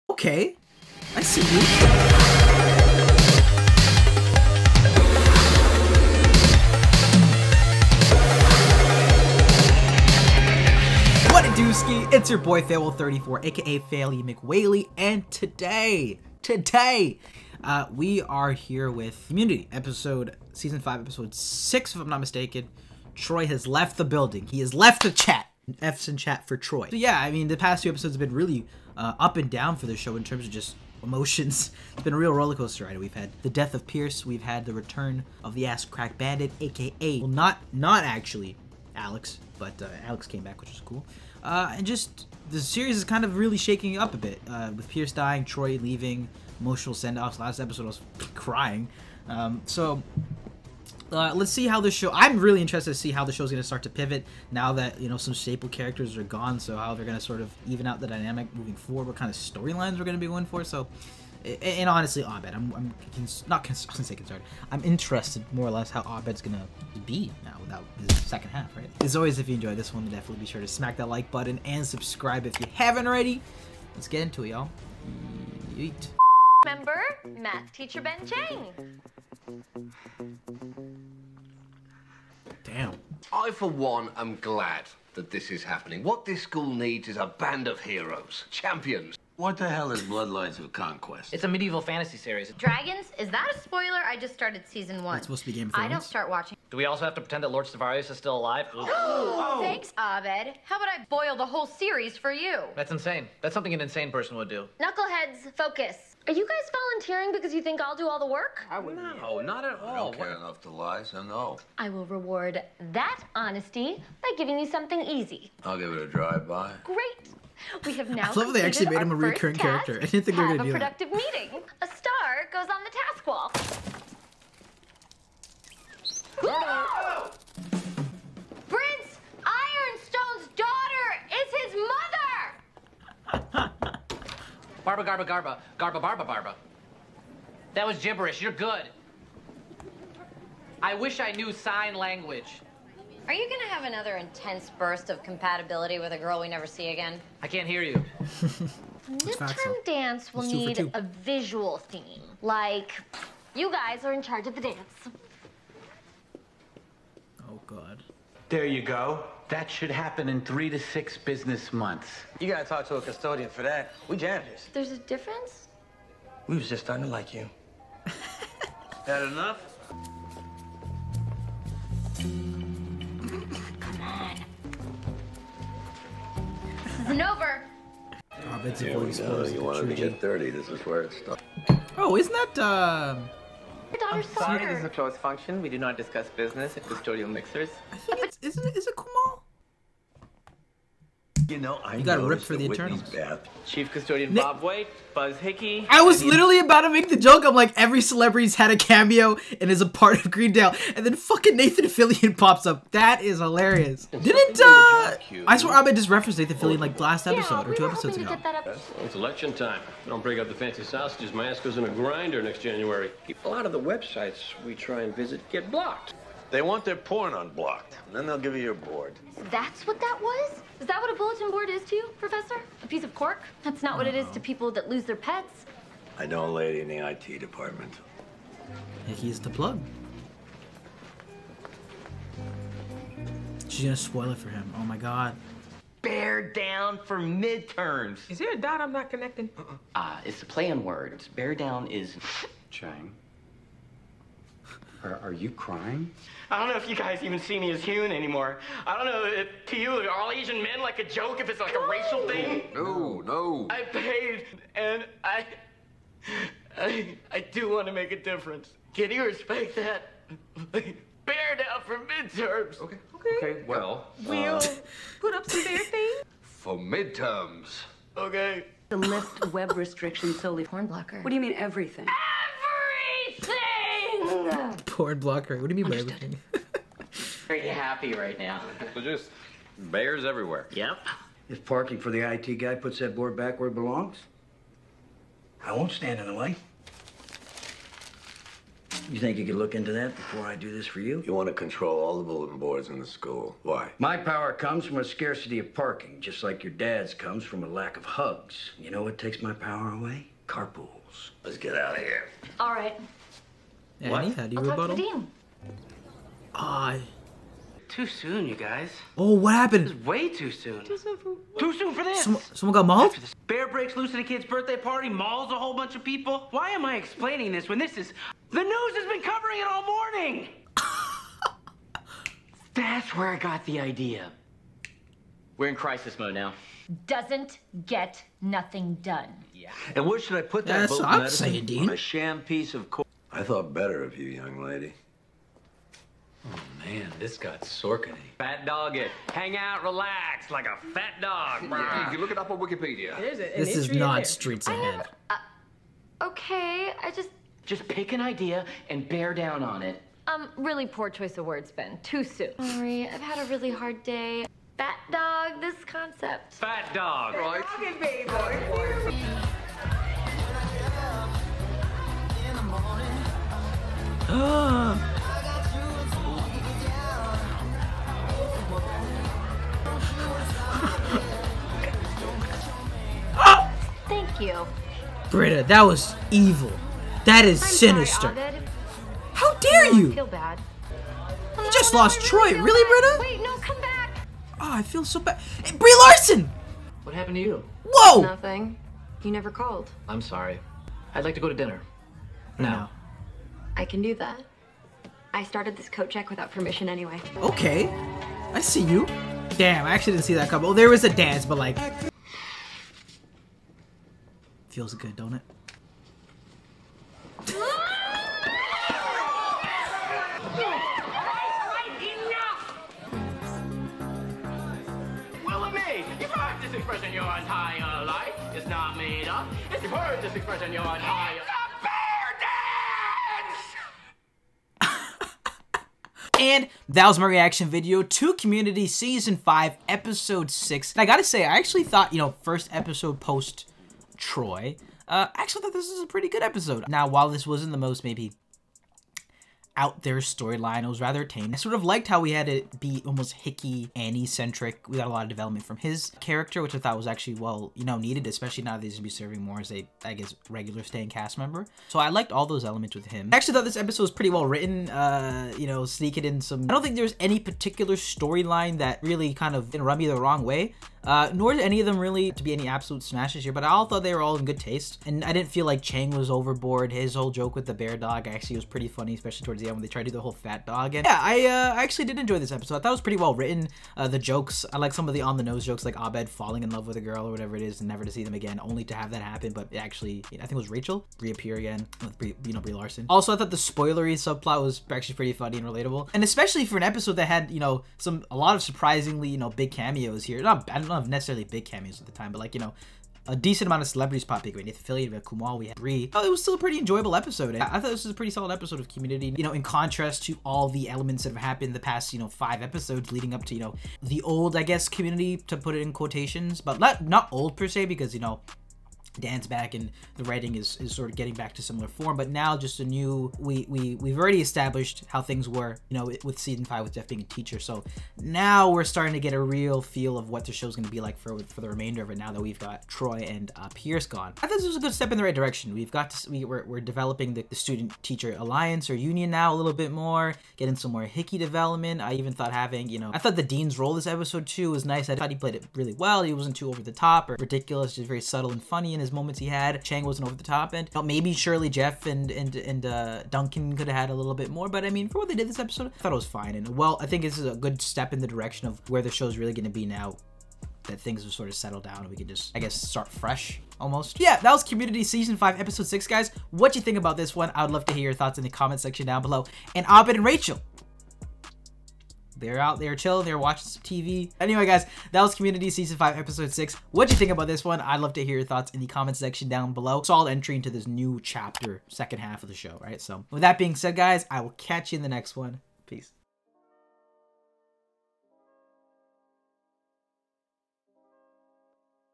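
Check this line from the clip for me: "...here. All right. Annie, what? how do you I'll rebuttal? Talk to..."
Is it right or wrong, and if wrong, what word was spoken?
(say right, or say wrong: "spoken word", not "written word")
right.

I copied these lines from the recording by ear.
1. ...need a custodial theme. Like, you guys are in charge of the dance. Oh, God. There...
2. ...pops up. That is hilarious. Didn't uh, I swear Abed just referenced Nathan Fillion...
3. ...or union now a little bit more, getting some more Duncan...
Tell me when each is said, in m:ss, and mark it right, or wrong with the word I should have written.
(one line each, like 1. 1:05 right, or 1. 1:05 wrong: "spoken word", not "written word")
1. 2:30 wrong: "visual", not "custodial"
2. 3:22 right
3. 8:48 wrong: "Hickey", not "Duncan".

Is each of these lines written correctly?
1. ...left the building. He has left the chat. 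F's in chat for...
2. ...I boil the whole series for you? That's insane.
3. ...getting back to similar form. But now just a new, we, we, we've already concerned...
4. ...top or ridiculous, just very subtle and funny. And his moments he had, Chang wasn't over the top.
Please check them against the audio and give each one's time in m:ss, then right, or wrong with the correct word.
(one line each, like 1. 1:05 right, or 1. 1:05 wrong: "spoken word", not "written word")
1. 0:23 right
2. 1:40 right
3. 8:31 wrong: "established", not "concerned"
4. 8:56 right.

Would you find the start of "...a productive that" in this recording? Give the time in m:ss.
2:00.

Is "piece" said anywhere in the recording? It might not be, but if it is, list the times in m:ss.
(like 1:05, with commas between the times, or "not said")
3:42, 5:32.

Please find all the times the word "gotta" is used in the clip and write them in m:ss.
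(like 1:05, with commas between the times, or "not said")
2:42, 7:11.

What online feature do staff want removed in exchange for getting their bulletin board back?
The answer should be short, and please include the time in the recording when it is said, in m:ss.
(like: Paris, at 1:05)
Porn blocker, at 4:34.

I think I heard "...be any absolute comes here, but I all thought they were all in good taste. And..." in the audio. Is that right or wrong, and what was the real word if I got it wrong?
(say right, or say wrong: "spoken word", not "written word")
wrong: "smashes", not "comes".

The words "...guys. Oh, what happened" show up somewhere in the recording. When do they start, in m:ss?
5:08.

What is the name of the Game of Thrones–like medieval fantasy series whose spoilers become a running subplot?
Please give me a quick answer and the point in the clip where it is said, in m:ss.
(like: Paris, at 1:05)
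Bloodlines of Conquest, at 1:30.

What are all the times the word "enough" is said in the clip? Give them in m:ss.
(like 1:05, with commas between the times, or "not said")
1:50, 2:49.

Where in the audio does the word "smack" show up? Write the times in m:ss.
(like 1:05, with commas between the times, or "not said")
1:10.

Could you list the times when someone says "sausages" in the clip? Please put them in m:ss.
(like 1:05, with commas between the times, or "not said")
3:30.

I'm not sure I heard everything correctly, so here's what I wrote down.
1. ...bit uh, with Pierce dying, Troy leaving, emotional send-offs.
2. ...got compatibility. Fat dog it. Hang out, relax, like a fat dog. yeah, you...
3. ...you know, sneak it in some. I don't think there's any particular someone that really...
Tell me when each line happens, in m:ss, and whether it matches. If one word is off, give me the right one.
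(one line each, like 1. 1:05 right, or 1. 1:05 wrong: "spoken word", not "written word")
1. 0:44 right
2. 5:37 wrong: "sorkety", not "compatibility"
3. 7:35 wrong: "storyline", not "someone".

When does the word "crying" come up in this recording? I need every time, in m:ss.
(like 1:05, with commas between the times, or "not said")
0:48, 4:05.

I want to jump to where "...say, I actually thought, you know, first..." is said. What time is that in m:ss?
7:11.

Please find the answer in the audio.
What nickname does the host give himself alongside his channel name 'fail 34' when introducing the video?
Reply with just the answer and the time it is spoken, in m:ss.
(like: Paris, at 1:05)
Faily McWhaley, at 0:13.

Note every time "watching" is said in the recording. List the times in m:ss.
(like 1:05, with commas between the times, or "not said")
1:36, 9:23.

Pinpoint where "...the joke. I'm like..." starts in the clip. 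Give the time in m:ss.
3:17.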